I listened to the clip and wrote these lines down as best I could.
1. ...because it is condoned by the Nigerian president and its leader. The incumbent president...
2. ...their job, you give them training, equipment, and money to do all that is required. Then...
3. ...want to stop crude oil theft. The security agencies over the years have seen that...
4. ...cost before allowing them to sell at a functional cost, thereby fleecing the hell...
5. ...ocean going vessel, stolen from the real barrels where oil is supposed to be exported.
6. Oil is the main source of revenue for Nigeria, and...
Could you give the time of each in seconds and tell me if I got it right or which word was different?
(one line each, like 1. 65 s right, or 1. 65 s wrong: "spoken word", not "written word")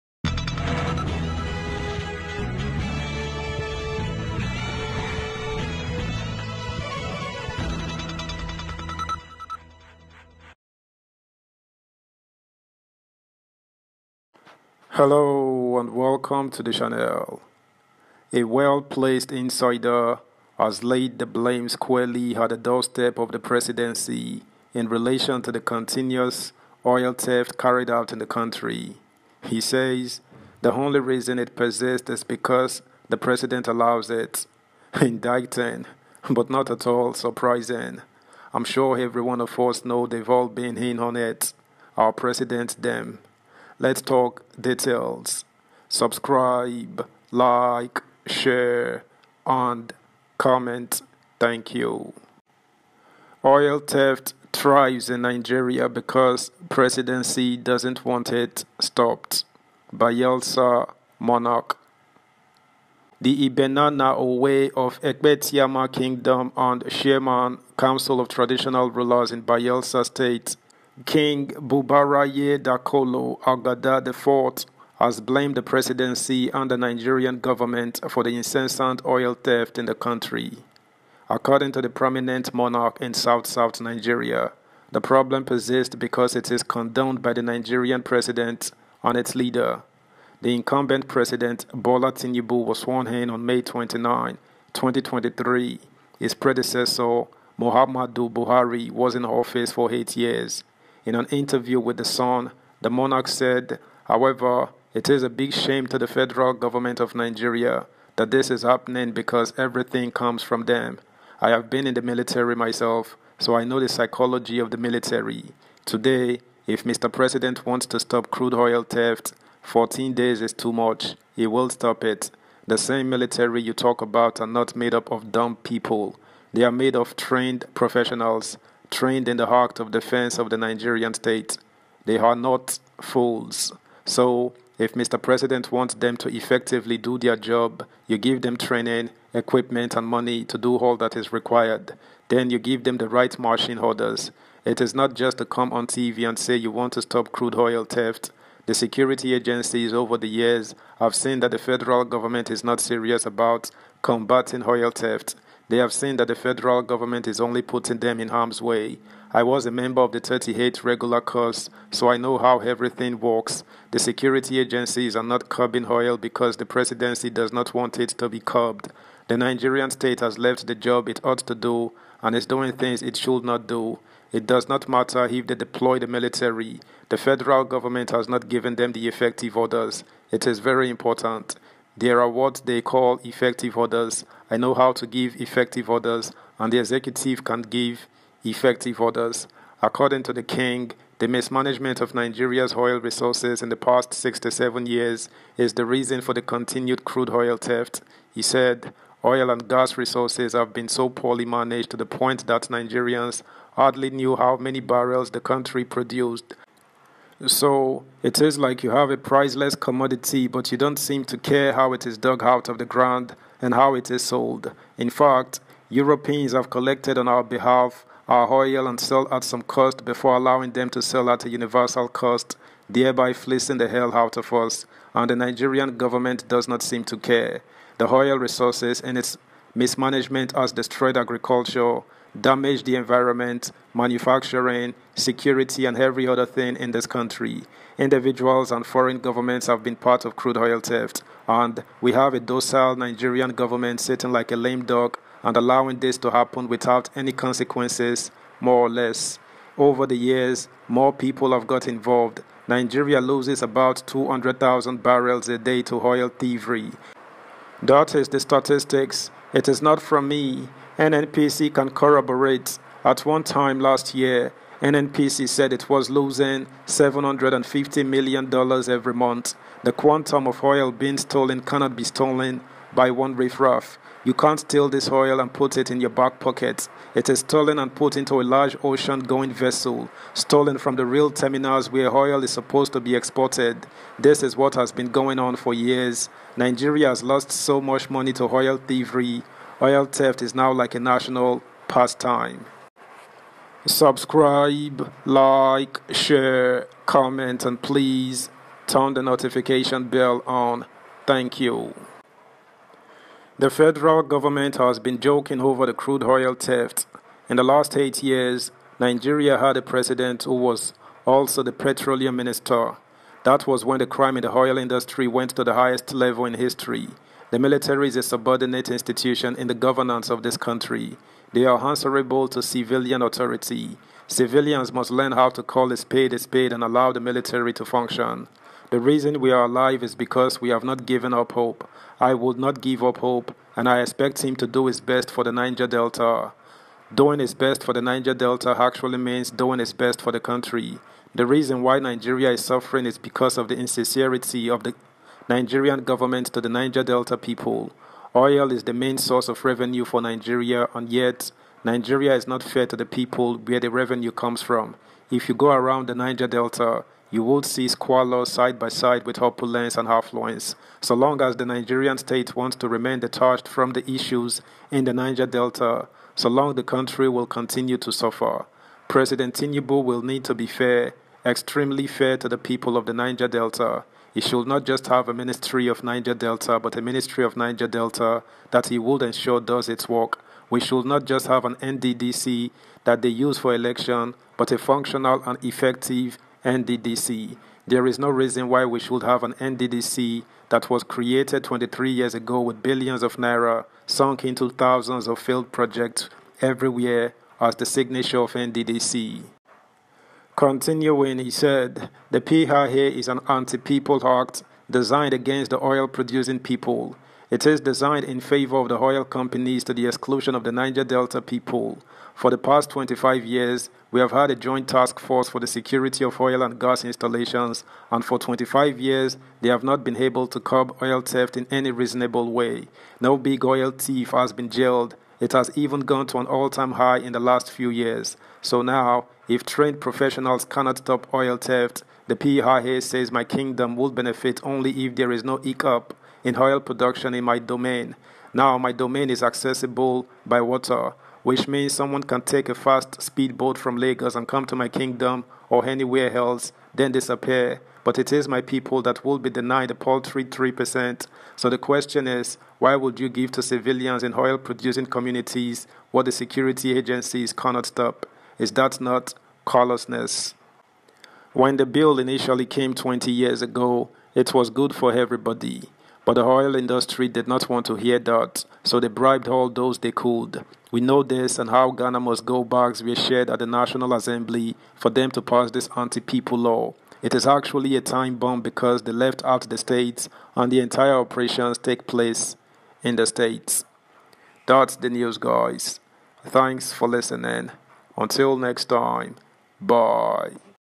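1. 85 s right
2. 137 s right
3. 146 s right
4. 219 s wrong: "universal", not "functional"
5. 278 s wrong: "terminals", not "barrels"
6. 348 s right.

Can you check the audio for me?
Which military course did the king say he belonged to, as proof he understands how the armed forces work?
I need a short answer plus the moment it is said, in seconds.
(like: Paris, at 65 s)
38 regular course, at 160 s.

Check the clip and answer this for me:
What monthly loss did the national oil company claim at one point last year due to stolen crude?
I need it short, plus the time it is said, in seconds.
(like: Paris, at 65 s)
$750 million, at 266 s.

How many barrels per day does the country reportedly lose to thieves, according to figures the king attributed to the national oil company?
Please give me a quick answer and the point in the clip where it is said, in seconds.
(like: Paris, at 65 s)
200,000, at 254 s.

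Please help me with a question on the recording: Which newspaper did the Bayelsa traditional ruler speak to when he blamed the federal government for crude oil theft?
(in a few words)
The Sun.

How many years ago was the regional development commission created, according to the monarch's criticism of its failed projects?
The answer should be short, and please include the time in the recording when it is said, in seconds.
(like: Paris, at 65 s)
23 years, at 391 s.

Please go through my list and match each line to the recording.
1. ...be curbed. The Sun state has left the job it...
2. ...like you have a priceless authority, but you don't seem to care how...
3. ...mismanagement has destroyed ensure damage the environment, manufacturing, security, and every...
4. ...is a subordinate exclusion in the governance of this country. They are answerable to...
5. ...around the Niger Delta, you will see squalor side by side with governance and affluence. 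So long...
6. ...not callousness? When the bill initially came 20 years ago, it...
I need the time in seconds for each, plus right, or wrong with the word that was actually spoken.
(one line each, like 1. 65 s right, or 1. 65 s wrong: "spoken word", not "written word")
1. 168 s wrong: "Nigerian", not "Sun"
2. 208 s wrong: "commodity", not "authority"
3. 229 s wrong: "agriculture", not "ensure"
4. 318 s wrong: "institution", not "exclusion"
5. 355 s wrong: "opulence", not "governance"
6. 458 s right.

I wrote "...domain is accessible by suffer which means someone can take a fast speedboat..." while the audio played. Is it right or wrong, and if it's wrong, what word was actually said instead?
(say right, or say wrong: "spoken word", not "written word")
wrong: "water", not "suffer".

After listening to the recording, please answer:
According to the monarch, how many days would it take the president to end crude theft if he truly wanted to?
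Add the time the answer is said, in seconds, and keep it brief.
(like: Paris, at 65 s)
14 days, at 119 s.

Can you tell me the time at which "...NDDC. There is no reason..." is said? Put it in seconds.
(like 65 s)
386 s.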